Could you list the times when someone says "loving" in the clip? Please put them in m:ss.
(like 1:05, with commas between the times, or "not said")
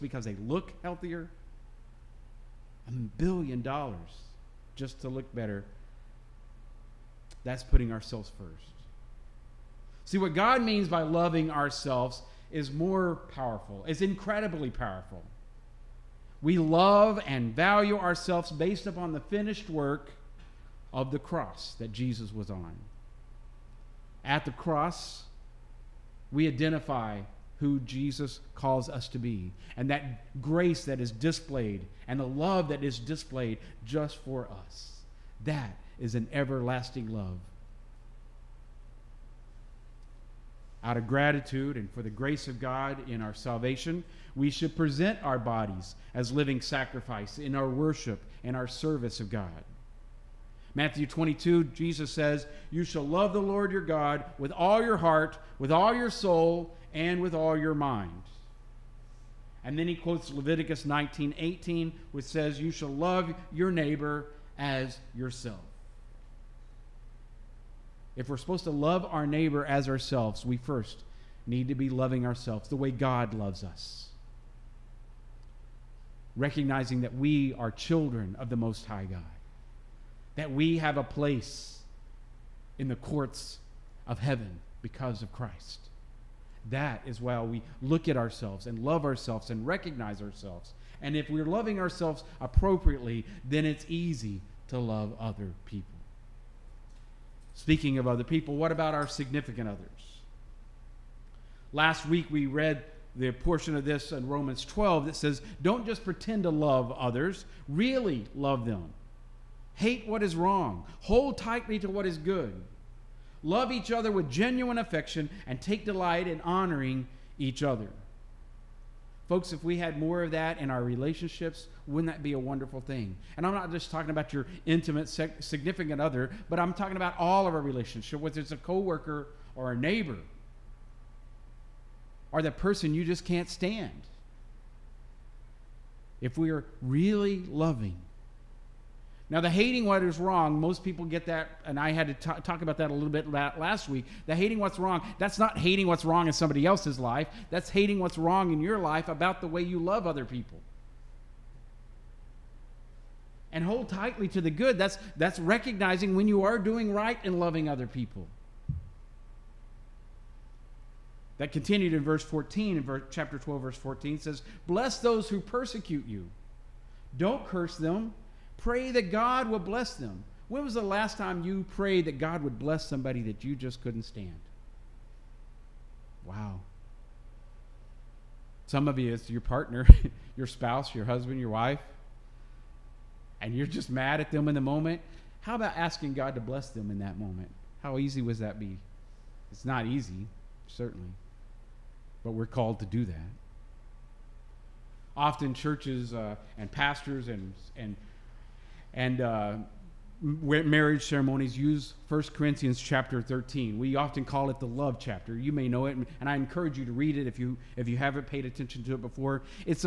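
0:11, 1:11, 1:31, 2:17, 2:37.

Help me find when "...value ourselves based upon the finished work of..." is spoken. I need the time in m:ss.
0:17.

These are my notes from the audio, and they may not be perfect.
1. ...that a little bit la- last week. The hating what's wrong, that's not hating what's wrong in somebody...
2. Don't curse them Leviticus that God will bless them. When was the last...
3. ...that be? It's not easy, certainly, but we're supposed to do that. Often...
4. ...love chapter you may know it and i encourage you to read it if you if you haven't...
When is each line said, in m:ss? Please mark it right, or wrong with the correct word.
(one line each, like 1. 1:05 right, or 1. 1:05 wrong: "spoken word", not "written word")
1. 2:22 right
2. 2:47 wrong: "Pray", not "Leviticus"
3. 3:08 wrong: "called", not "supposed"
4. 3:24 right.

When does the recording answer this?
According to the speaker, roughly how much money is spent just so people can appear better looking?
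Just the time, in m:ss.
0:02.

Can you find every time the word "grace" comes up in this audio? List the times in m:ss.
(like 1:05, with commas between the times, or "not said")
0:30, 0:42.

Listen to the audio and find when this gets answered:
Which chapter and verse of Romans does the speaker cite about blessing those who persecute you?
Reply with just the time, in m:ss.
2:43.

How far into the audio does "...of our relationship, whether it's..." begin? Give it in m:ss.
2:07.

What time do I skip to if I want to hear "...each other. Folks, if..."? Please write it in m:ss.
1:57.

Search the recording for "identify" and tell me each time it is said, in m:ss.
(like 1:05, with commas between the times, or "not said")
0:26.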